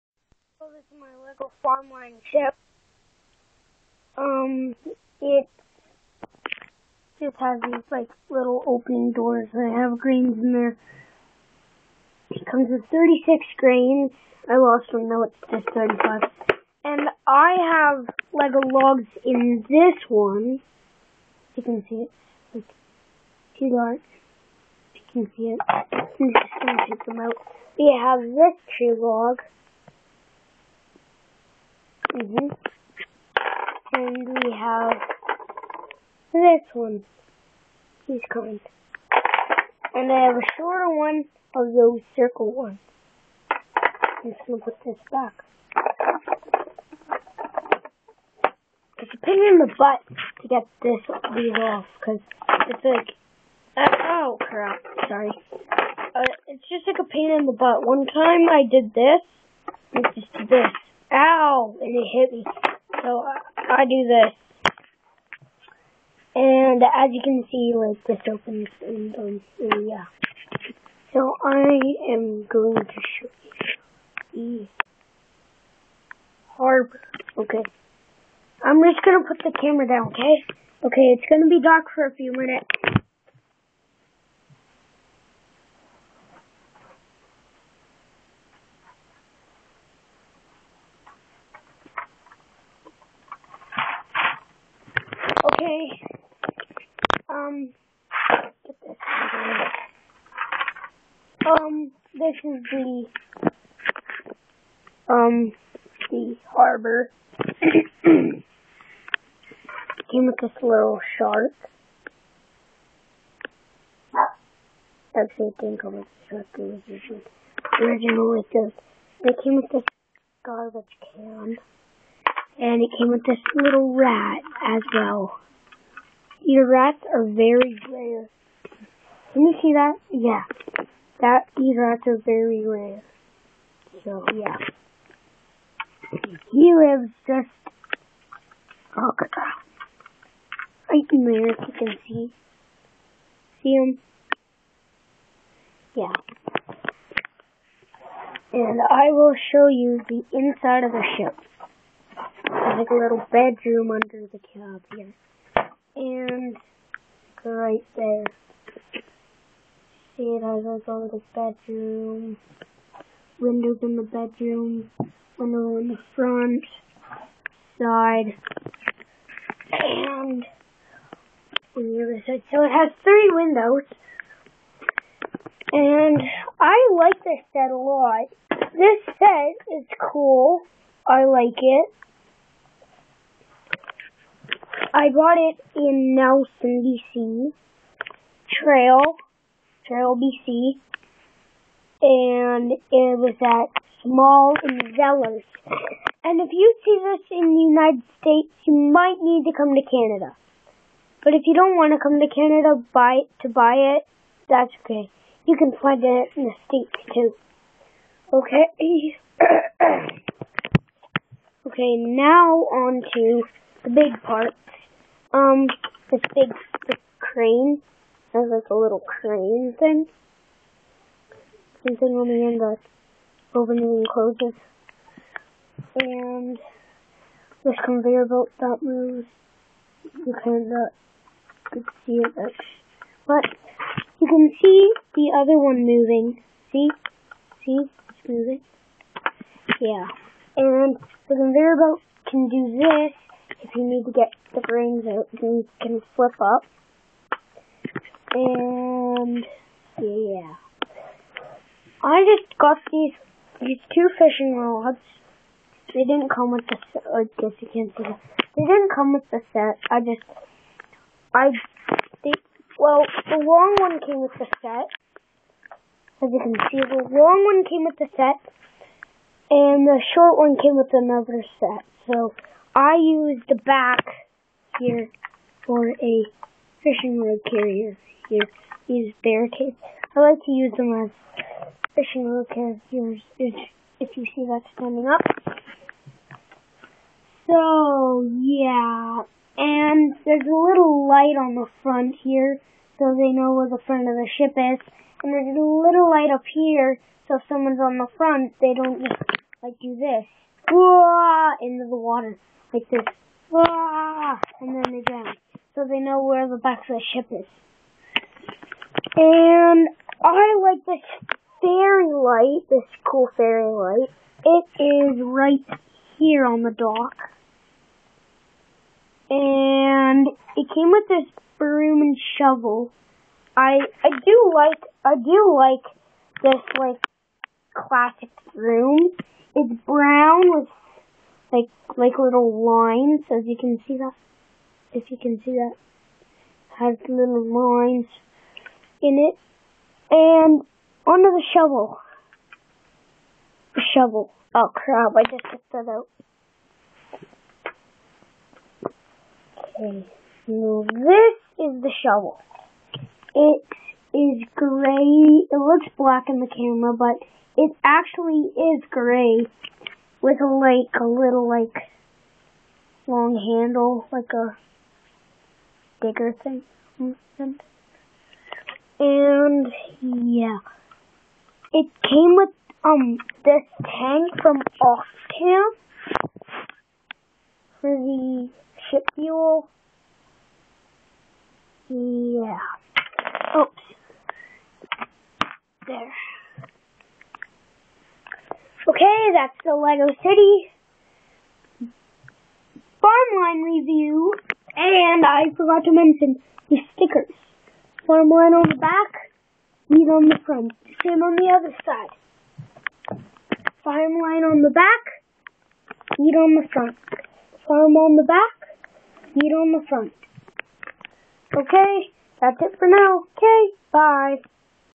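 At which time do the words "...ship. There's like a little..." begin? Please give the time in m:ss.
2:31.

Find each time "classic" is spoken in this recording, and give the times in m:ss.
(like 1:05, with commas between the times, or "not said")
5:27.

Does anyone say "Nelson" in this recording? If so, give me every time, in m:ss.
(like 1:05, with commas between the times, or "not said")
3:06.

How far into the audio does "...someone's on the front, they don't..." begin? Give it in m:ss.
4:57.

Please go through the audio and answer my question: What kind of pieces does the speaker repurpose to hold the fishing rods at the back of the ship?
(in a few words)
barricades.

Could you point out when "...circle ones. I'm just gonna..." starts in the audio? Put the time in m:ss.
0:42.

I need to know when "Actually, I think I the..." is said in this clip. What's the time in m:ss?
1:55.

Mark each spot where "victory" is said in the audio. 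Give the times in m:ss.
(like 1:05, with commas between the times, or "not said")
not said.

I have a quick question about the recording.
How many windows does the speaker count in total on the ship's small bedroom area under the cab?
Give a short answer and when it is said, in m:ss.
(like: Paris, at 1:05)
3, at 2:53.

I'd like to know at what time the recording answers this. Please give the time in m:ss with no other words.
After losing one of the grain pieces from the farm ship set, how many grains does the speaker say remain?
0:15.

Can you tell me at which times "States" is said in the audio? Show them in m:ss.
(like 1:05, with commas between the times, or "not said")
3:18, 3:26.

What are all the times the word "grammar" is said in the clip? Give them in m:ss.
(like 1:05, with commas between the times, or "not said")
not said.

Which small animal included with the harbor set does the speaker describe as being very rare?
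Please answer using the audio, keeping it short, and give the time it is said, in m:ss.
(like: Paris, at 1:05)
rat, at 2:03.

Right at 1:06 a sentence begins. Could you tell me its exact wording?
And as you can see, like, this opens and, um, and yeah.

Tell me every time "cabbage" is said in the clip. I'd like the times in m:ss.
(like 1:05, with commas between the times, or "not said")
not said.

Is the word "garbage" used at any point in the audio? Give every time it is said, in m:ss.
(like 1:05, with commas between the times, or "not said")
2:00.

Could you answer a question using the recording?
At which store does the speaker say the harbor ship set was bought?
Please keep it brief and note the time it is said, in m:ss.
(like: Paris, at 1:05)
Zellers, at 3:14.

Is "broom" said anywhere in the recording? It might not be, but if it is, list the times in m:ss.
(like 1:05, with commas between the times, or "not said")
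5:21, 5:28.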